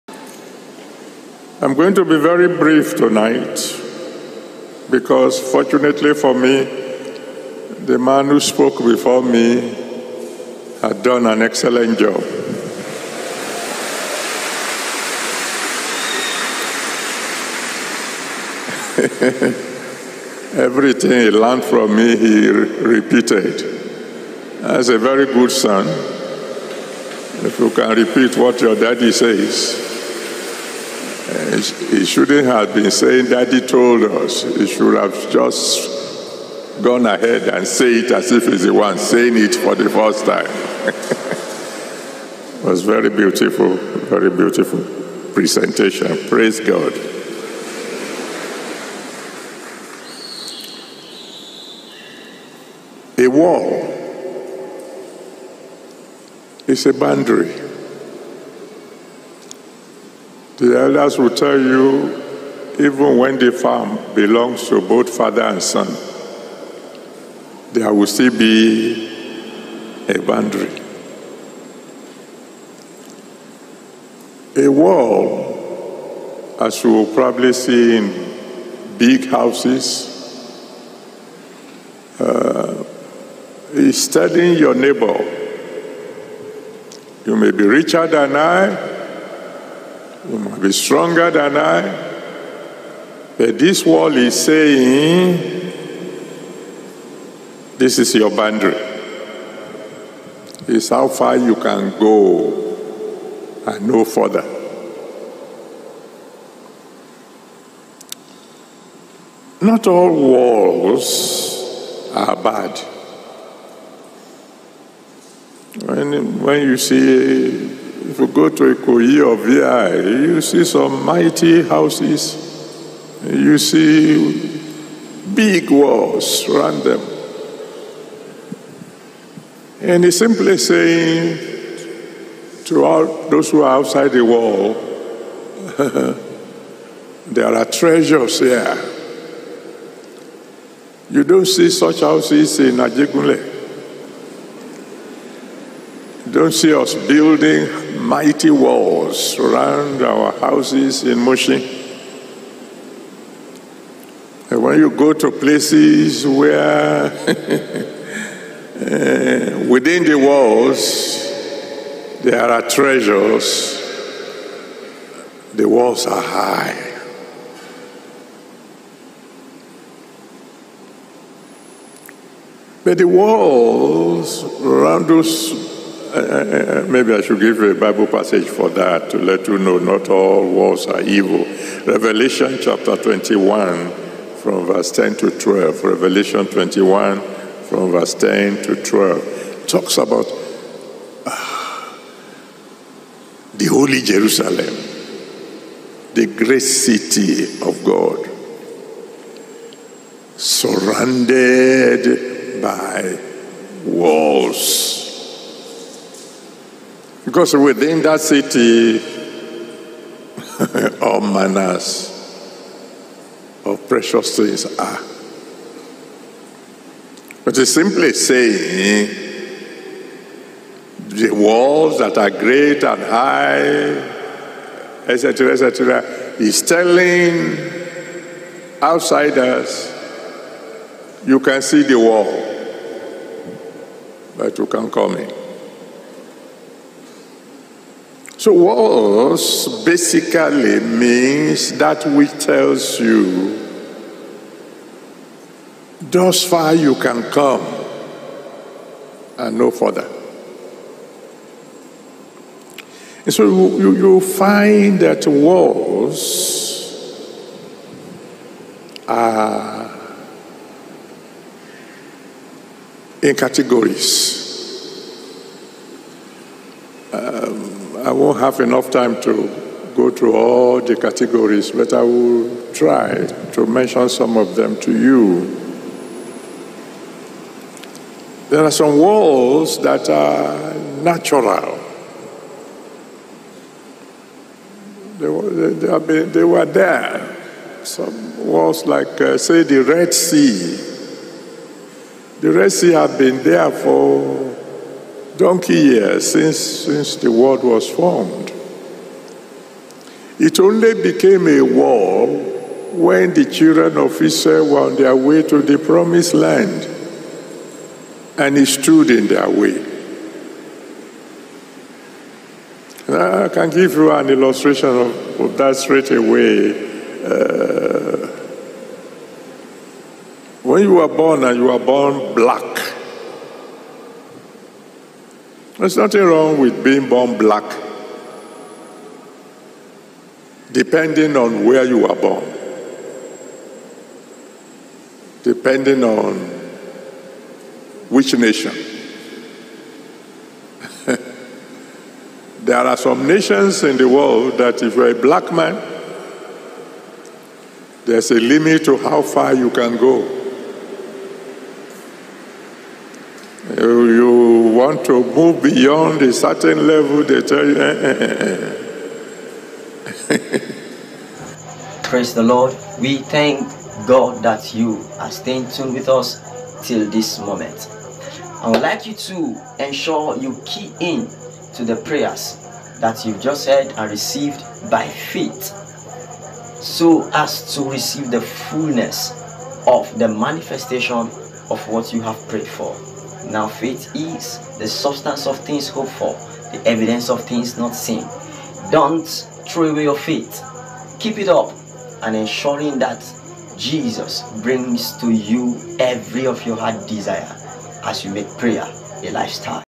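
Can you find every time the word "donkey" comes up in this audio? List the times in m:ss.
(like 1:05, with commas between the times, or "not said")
4:55.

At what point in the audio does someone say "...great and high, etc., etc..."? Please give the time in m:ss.
3:42.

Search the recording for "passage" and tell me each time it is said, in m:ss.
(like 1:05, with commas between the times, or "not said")
2:58.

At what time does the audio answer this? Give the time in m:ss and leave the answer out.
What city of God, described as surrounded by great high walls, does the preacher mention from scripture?
3:13.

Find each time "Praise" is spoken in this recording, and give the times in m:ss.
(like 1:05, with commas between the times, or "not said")
0:46, 6:02.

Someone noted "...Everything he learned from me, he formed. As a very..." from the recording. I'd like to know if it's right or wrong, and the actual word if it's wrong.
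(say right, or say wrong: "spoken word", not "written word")
wrong: "repeated", not "formed".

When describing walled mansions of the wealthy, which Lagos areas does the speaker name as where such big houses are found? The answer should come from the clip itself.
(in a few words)
Ikoyi or VI.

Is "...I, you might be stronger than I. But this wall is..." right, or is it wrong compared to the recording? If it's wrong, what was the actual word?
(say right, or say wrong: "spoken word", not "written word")
right.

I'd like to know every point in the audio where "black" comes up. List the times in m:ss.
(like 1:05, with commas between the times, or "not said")
5:22, 5:27, 5:45.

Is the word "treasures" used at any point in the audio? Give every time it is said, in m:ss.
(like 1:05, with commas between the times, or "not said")
2:17, 2:42.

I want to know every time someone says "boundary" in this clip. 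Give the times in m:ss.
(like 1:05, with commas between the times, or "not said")
0:56, 1:10, 1:38.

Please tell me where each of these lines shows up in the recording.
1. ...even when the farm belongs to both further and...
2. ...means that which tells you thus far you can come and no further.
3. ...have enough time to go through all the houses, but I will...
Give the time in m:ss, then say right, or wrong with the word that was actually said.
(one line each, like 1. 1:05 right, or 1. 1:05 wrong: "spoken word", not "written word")
1. 1:02 wrong: "father", not "further"
2. 4:00 right
3. 4:28 wrong: "categories", not "houses".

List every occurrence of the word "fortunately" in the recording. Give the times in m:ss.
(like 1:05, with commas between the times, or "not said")
0:05.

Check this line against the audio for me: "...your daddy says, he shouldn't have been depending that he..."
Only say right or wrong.
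wrong.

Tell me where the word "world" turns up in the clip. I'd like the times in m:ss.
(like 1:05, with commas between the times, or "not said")
4:57, 5:44.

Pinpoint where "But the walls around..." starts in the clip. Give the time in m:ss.
2:52.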